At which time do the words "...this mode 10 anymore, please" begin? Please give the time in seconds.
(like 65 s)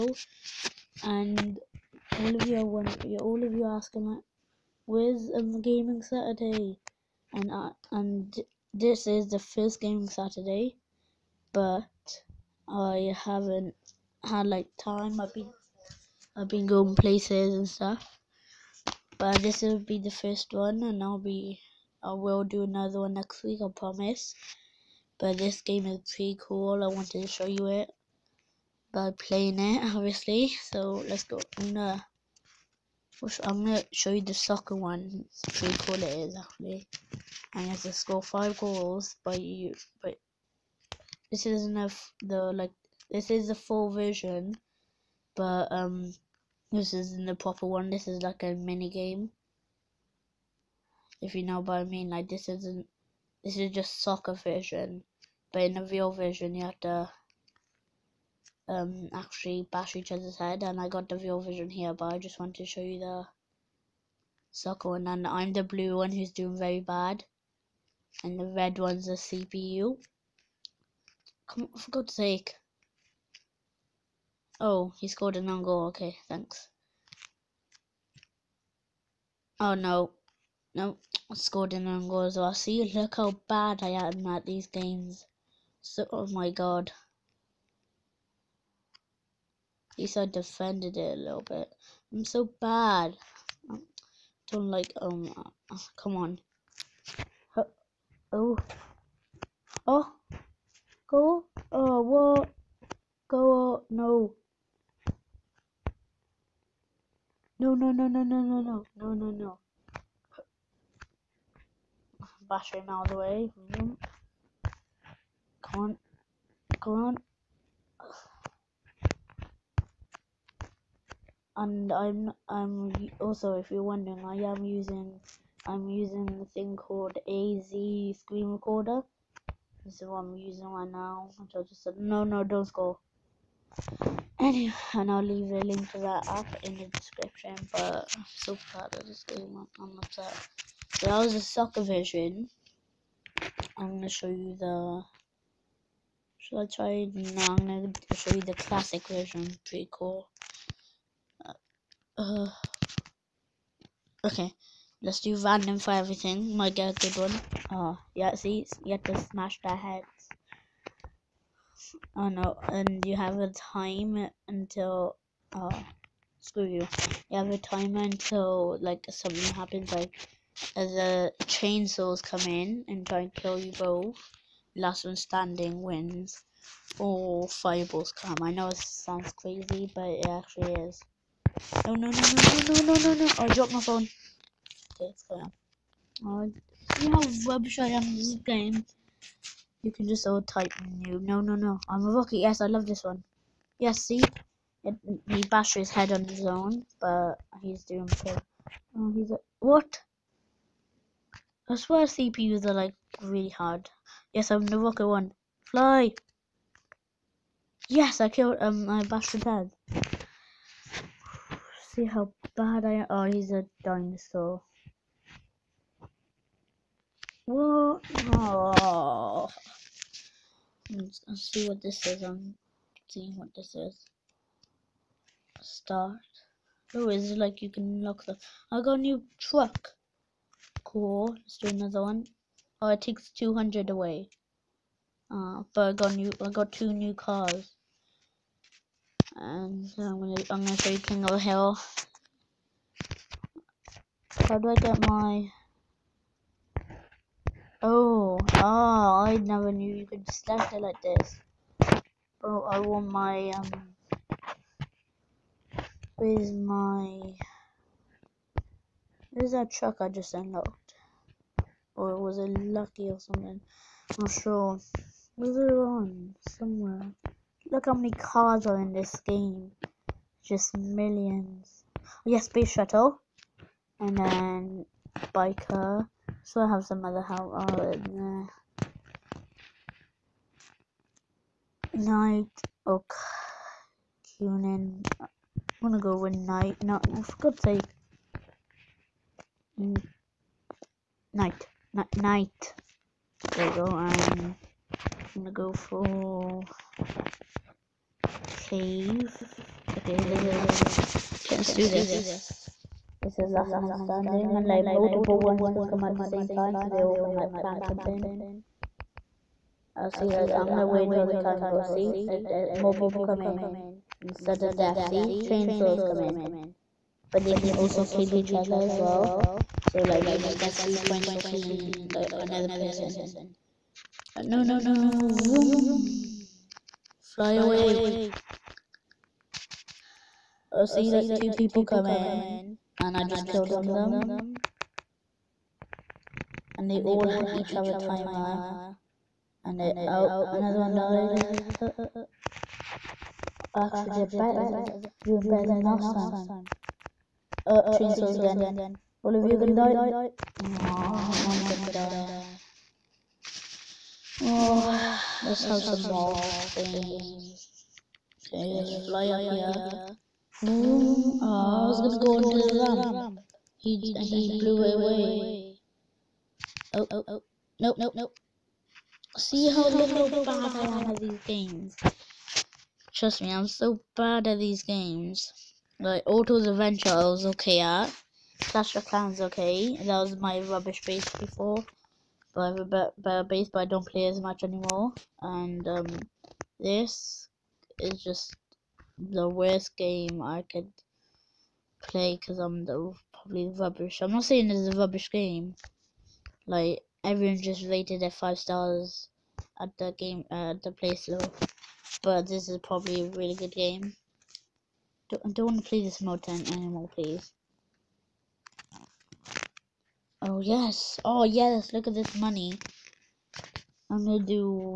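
406 s.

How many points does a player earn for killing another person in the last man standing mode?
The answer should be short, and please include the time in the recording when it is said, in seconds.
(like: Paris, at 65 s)
3, at 320 s.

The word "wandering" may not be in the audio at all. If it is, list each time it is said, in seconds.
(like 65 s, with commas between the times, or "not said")
not said.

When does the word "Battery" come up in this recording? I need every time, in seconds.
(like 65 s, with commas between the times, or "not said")
112 s.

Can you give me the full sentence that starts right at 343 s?
I actually did better, doing better than last time.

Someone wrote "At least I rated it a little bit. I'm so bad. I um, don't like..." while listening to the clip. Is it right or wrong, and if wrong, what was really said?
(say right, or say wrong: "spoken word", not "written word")
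wrong: "defended", not "rated".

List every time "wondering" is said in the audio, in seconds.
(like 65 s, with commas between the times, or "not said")
2 s, 123 s.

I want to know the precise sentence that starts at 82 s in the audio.
See, look how bad I am at these games.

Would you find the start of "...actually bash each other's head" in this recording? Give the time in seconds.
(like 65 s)
59 s.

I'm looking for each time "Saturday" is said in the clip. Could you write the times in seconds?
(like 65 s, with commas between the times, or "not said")
6 s, 10 s.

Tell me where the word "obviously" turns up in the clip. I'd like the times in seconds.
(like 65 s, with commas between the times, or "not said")
29 s.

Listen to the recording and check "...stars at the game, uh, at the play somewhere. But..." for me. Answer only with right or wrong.
wrong.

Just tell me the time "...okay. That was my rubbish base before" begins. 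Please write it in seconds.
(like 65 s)
379 s.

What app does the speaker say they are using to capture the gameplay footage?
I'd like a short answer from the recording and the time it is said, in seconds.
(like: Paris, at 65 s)
AZ screen recorder, at 127 s.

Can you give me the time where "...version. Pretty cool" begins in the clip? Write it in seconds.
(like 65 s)
149 s.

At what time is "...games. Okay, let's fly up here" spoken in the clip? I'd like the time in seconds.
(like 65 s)
356 s.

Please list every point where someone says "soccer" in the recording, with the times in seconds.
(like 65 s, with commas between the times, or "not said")
34 s, 54 s, 64 s, 141 s.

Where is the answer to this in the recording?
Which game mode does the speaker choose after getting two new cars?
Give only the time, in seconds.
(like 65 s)
240 s.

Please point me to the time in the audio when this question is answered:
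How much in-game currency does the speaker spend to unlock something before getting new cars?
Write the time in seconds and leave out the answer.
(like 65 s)
233 s.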